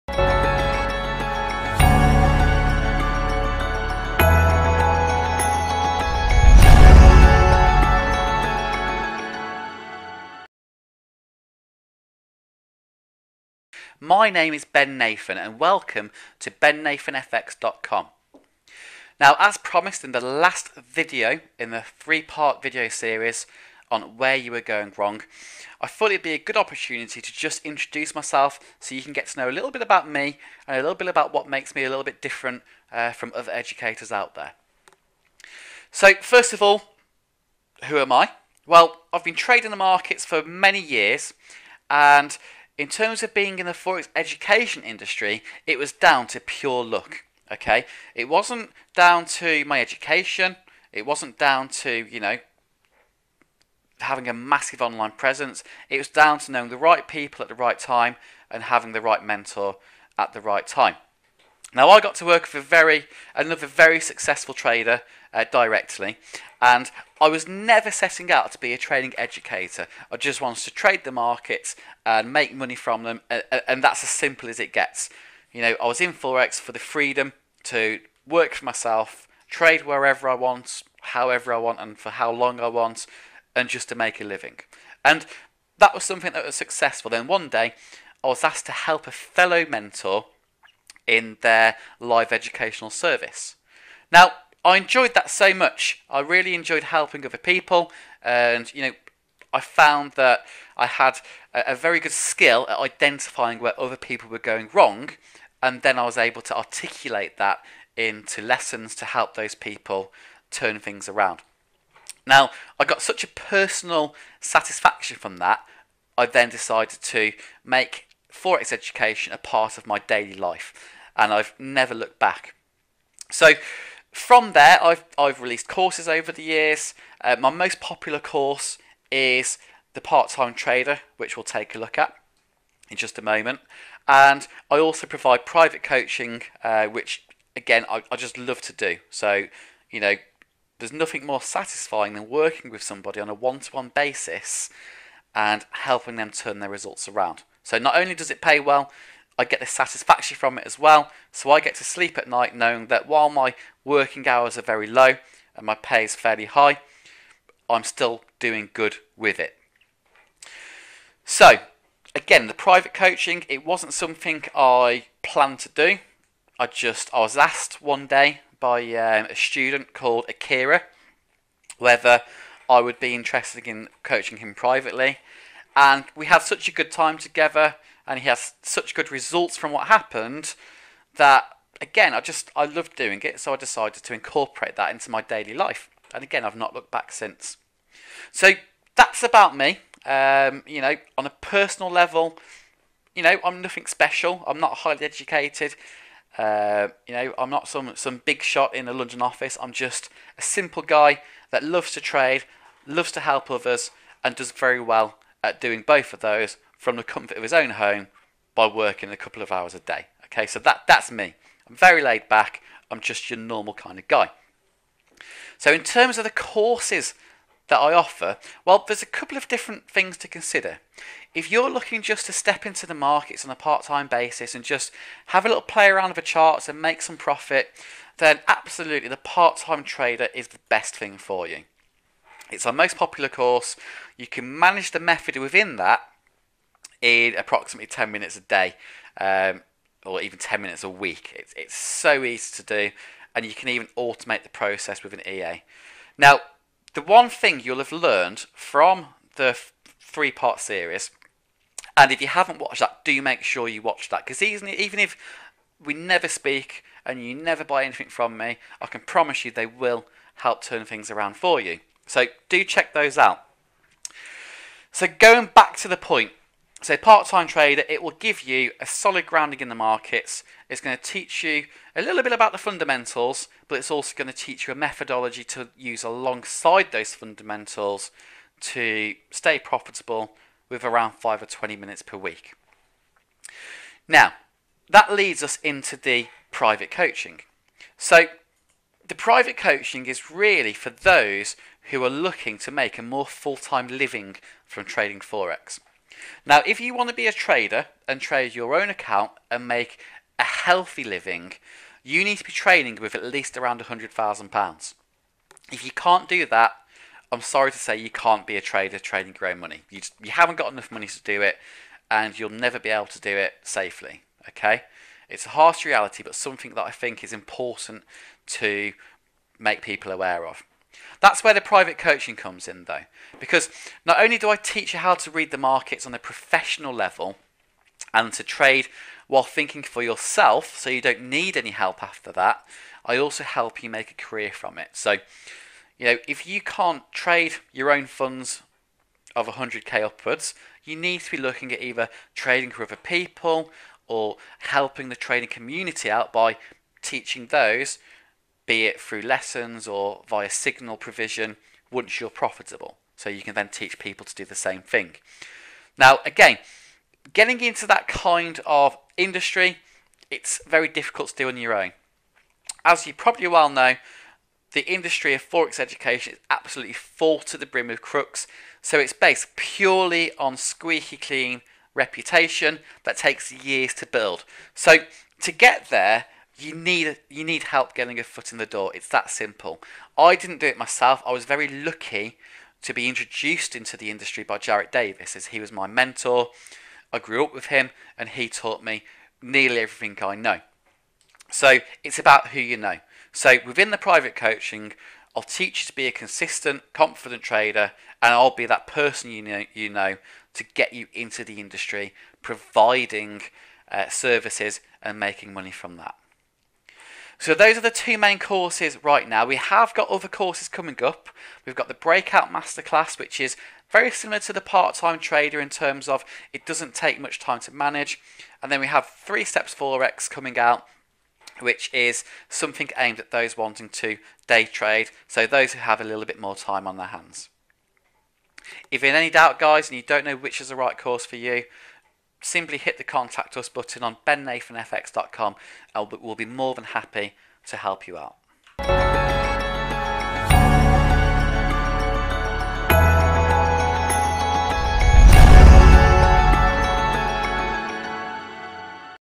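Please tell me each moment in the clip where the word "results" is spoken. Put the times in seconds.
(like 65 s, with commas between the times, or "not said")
146 s, 179 s.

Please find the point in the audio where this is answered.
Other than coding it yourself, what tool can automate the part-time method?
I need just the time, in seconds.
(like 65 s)
245 s.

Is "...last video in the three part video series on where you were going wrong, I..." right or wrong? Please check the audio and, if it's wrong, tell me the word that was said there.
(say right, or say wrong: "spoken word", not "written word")
right.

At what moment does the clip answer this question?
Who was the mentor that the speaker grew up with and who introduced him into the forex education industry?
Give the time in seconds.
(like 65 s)
384 s.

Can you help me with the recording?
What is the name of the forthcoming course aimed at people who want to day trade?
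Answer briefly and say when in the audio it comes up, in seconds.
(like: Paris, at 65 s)
Three Steps Forex, at 419 s.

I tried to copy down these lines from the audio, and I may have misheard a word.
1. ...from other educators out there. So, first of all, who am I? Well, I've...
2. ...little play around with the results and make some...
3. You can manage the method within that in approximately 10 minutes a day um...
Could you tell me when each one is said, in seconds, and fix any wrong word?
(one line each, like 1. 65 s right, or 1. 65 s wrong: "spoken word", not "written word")
1. 33 s right
2. 225 s wrong: "charts", not "results"
3. 234 s right.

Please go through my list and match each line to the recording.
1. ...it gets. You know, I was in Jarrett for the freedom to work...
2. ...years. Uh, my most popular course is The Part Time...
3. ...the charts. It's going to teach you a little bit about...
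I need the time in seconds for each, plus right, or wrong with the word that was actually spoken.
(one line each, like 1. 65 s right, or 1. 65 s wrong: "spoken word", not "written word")
1. 74 s wrong: "Forex", not "Jarrett"
2. 126 s right
3. 269 s wrong: "markets", not "charts".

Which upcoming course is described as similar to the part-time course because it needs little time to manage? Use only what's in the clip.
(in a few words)
Breakout Masterclass.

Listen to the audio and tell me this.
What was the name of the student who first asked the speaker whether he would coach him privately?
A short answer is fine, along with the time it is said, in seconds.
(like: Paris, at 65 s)
Akira, at 170 s.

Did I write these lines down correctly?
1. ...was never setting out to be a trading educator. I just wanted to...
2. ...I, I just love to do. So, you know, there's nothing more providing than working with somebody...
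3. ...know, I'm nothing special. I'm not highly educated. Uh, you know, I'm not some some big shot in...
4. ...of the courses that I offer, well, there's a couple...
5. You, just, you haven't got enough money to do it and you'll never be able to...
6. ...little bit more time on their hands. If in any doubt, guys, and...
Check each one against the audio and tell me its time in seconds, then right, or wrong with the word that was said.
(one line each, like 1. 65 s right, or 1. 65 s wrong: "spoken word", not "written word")
1. 67 s right
2. 137 s wrong: "satisfying", not "providing"
3. 193 s right
4. 216 s right
5. 309 s right
6. 426 s right.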